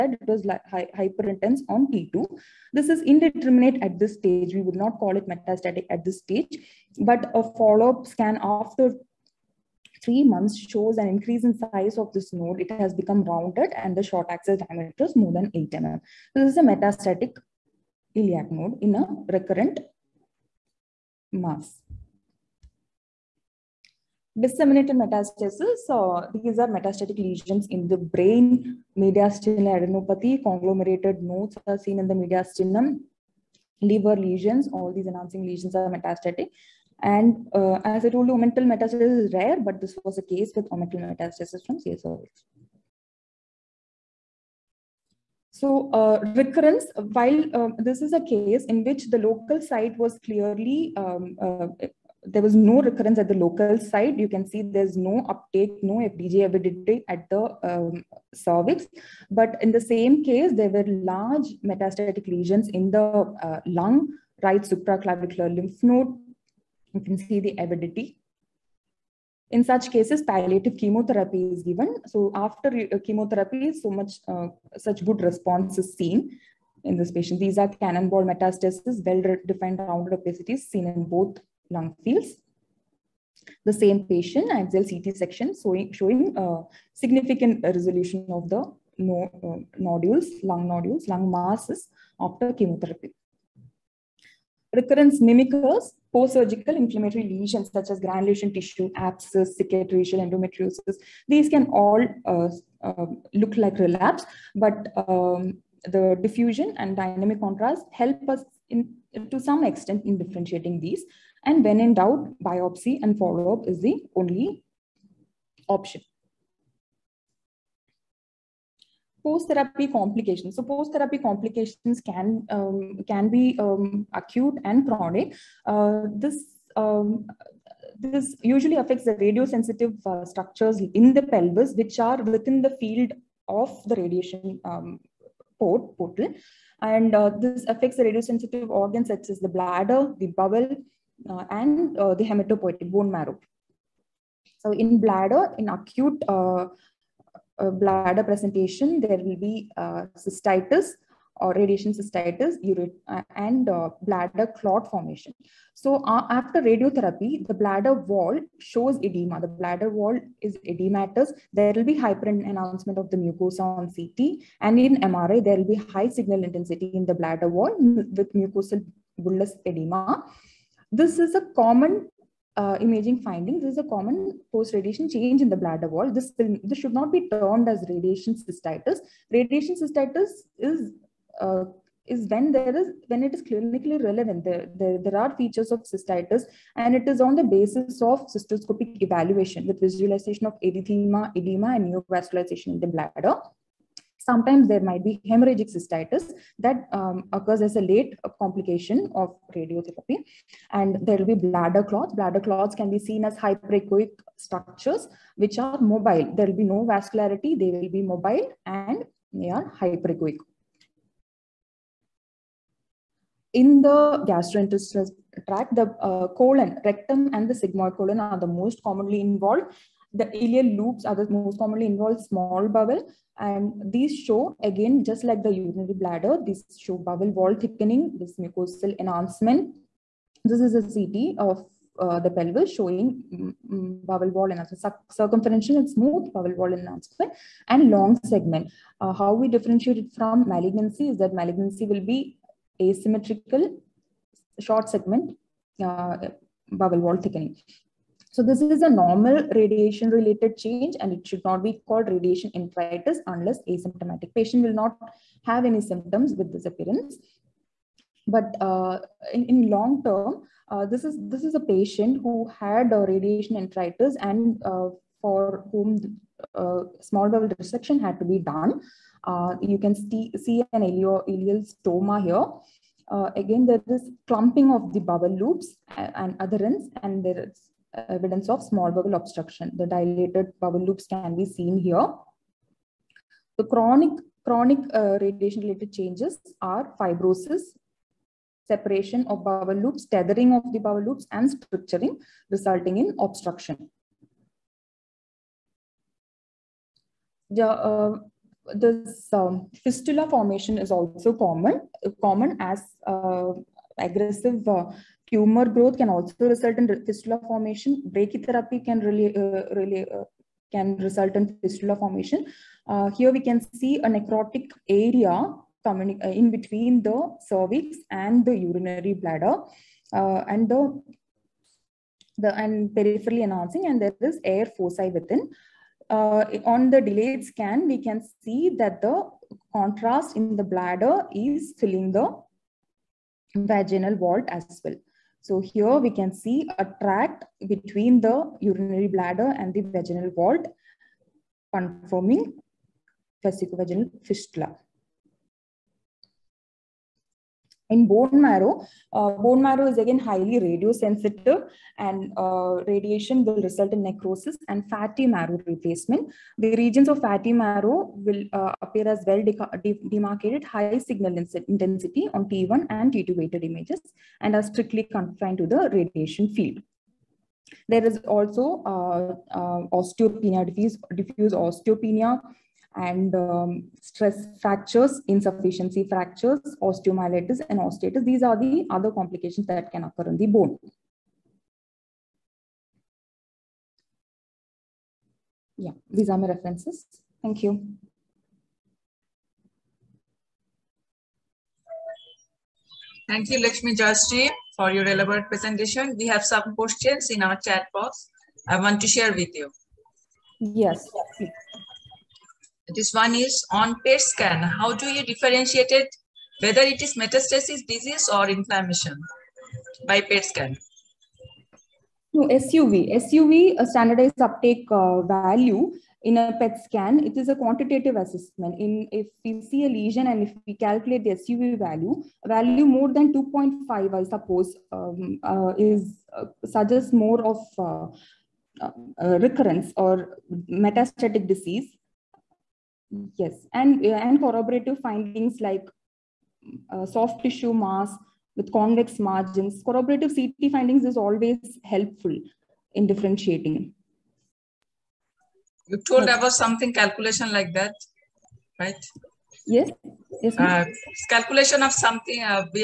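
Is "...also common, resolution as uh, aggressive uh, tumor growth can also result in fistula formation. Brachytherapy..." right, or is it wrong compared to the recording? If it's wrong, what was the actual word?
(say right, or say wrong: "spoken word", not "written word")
wrong: "common", not "resolution".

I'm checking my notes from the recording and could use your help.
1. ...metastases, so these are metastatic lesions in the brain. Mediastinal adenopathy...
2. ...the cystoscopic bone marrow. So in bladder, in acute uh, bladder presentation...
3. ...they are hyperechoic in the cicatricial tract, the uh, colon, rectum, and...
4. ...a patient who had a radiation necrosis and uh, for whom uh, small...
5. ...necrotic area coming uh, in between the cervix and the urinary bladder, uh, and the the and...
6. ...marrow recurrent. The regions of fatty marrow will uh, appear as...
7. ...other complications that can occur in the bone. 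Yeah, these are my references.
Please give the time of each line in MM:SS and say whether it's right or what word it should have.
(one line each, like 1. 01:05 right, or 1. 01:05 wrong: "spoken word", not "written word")
1. 00:25 right
2. 02:22 wrong: "hematopoietic", not "cystoscopic"
3. 03:29 wrong: "gastrointestinal", not "cicatricial"
4. 04:21 wrong: "enteritis", not "necrosis"
5. 05:14 right
6. 05:55 wrong: "replacement", not "recurrent"
7. 06:18 right.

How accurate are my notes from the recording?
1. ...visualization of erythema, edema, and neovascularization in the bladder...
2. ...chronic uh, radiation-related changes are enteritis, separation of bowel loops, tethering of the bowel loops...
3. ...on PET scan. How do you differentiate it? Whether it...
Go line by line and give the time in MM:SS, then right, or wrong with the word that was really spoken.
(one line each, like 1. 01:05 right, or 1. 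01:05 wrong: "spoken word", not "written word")
1. 03:09 right
2. 04:44 wrong: "fibrosis", not "enteritis"
3. 06:43 right.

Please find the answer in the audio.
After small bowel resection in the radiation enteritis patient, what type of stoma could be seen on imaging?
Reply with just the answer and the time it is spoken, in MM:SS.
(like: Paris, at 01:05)
ileal stoma, at 04:31.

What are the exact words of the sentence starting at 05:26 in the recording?
Uh, on the delayed scan, we can see that the contrast in the bladder is filling the vaginal vault as well.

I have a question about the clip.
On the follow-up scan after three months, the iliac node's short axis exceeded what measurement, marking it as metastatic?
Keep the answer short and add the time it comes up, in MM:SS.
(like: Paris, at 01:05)
8 mm, at 00:15.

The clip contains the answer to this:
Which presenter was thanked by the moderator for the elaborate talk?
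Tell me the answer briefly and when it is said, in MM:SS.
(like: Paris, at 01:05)
Lakshmi Jastri, at 06:33.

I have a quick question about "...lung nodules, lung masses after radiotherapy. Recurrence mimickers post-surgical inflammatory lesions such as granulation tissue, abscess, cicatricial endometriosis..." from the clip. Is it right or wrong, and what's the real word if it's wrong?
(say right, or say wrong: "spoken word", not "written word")
wrong: "chemotherapy", not "radiotherapy".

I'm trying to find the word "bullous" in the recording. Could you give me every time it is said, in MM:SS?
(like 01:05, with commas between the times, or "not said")
02:49.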